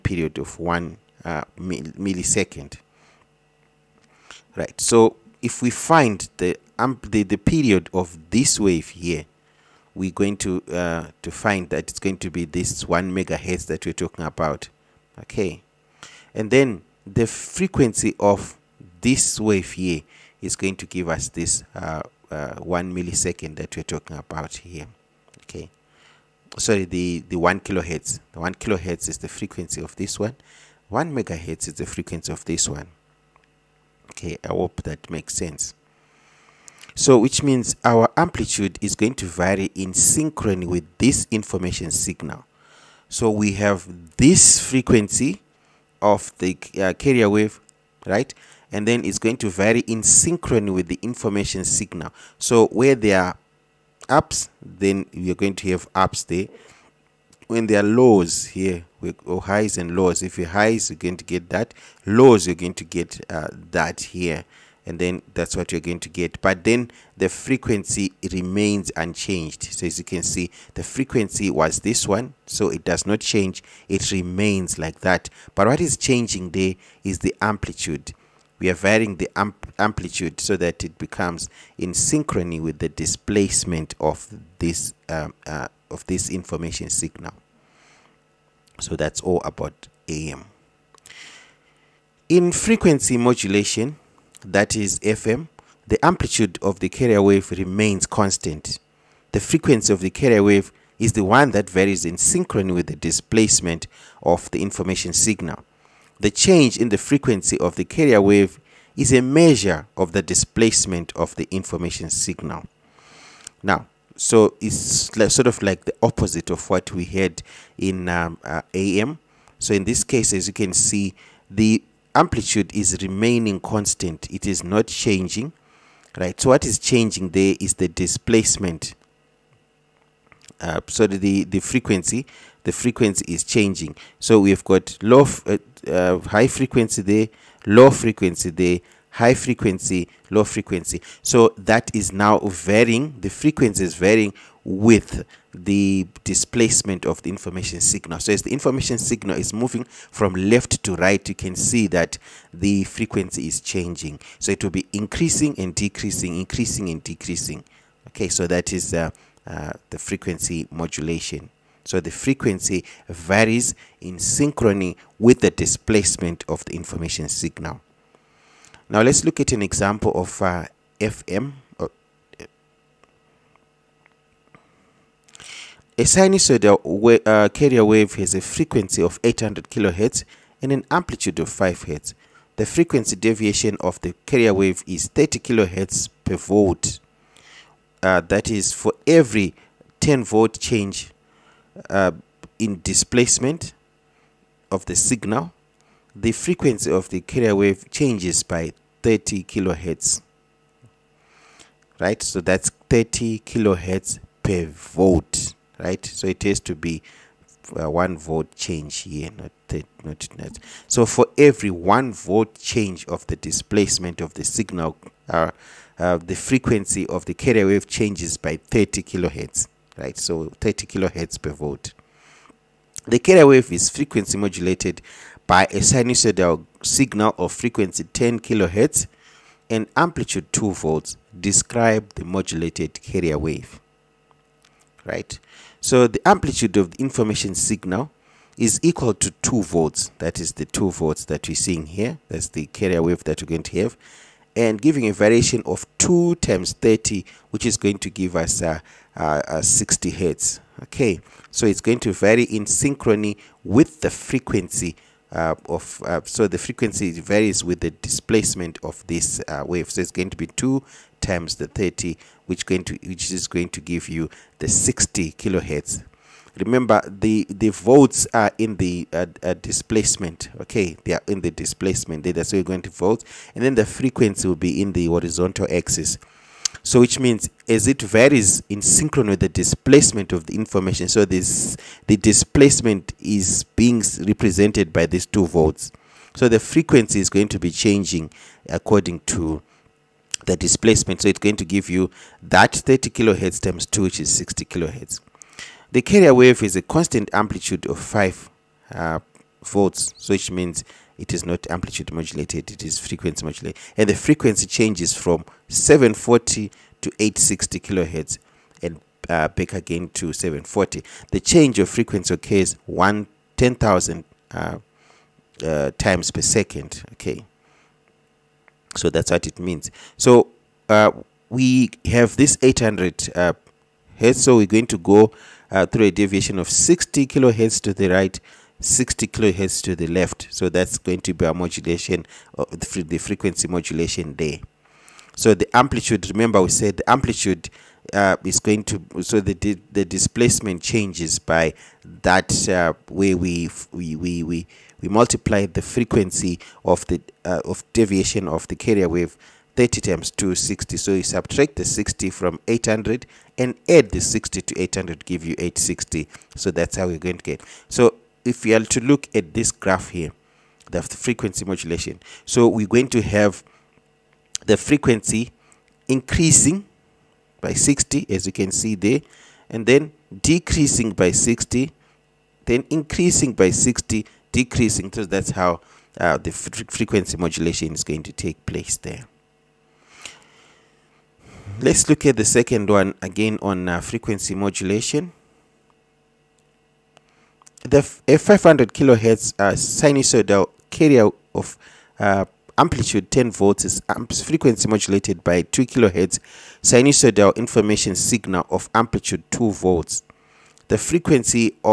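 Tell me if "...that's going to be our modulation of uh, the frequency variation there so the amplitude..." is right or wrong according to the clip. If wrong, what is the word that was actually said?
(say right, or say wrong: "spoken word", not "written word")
wrong: "modulation", not "variation".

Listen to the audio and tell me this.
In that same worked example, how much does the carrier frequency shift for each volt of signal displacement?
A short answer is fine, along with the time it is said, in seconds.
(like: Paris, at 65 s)
30 kHz per volt, at 185 s.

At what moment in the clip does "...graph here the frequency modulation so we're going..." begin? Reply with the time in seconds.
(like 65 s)
359 s.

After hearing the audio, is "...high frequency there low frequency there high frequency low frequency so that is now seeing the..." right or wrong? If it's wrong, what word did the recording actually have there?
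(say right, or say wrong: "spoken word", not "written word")
wrong: "varying", not "seeing".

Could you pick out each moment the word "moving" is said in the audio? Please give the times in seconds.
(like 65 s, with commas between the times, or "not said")
149 s.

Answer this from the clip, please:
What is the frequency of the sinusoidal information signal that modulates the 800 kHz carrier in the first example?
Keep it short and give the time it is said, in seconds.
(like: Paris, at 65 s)
10 kHz, at 228 s.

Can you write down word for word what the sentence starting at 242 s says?
That's the carrier wave that we're going to have.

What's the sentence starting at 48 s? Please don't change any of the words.
And then it's going to vary in synchrony with the information signal.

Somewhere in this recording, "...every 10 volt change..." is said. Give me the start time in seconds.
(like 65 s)
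189 s.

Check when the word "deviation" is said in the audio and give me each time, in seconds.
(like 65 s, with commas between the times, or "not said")
183 s, 326 s, 347 s.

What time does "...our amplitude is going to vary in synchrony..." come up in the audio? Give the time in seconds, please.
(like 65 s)
37 s.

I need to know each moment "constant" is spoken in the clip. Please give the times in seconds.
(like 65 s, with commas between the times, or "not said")
98 s, 123 s, 296 s.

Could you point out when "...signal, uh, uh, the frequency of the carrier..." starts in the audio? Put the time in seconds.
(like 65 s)
214 s.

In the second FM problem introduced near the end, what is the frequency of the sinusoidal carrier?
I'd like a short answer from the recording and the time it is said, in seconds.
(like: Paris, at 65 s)
500 kHz, at 388 s.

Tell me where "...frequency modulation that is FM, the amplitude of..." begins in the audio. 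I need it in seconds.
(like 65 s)
92 s.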